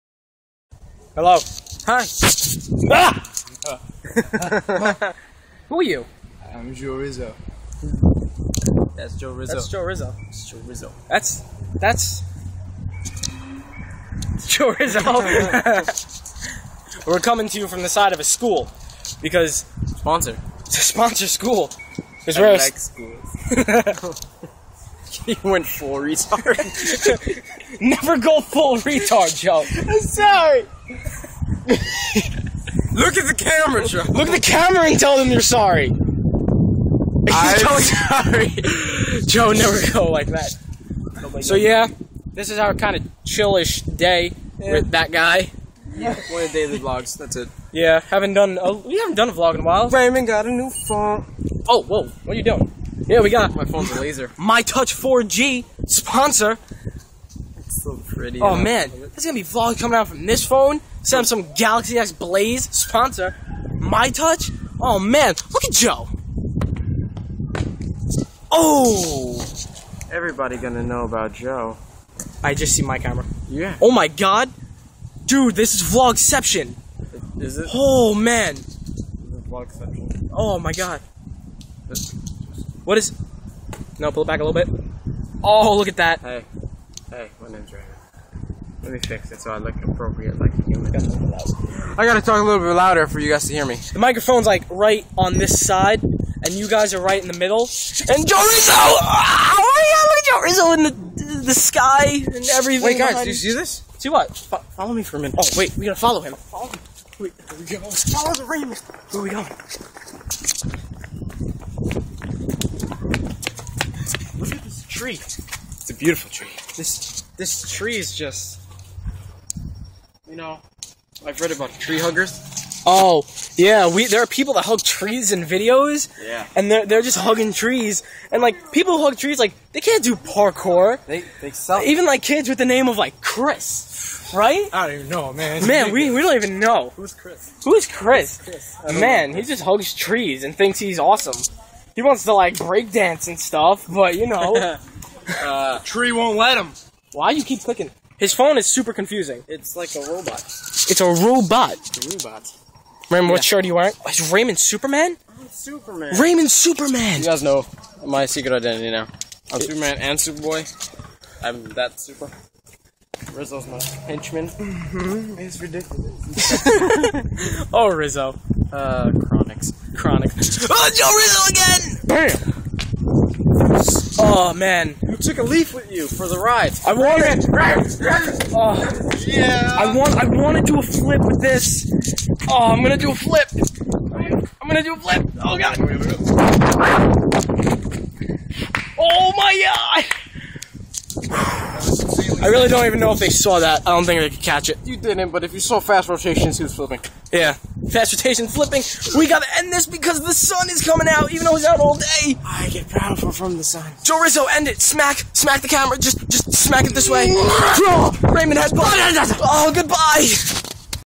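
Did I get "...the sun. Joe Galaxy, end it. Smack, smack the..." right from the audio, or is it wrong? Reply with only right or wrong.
wrong.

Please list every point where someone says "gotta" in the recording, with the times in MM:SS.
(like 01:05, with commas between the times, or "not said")
01:32, 01:45, 03:19.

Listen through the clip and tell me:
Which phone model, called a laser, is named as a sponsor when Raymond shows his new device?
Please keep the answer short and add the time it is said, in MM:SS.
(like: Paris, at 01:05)
My Touch 4G, at 00:54.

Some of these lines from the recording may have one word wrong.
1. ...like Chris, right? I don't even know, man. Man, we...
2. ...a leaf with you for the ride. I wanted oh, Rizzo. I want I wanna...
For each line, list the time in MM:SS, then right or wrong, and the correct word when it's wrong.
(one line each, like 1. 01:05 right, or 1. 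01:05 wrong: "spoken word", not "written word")
1. 02:12 right
2. 02:55 wrong: "Yeah", not "Rizzo".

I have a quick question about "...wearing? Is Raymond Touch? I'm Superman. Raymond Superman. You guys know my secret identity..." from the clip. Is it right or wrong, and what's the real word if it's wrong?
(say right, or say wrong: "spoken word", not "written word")
wrong: "Superman", not "Touch".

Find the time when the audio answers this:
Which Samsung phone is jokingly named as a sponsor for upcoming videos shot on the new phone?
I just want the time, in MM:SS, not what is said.
01:01.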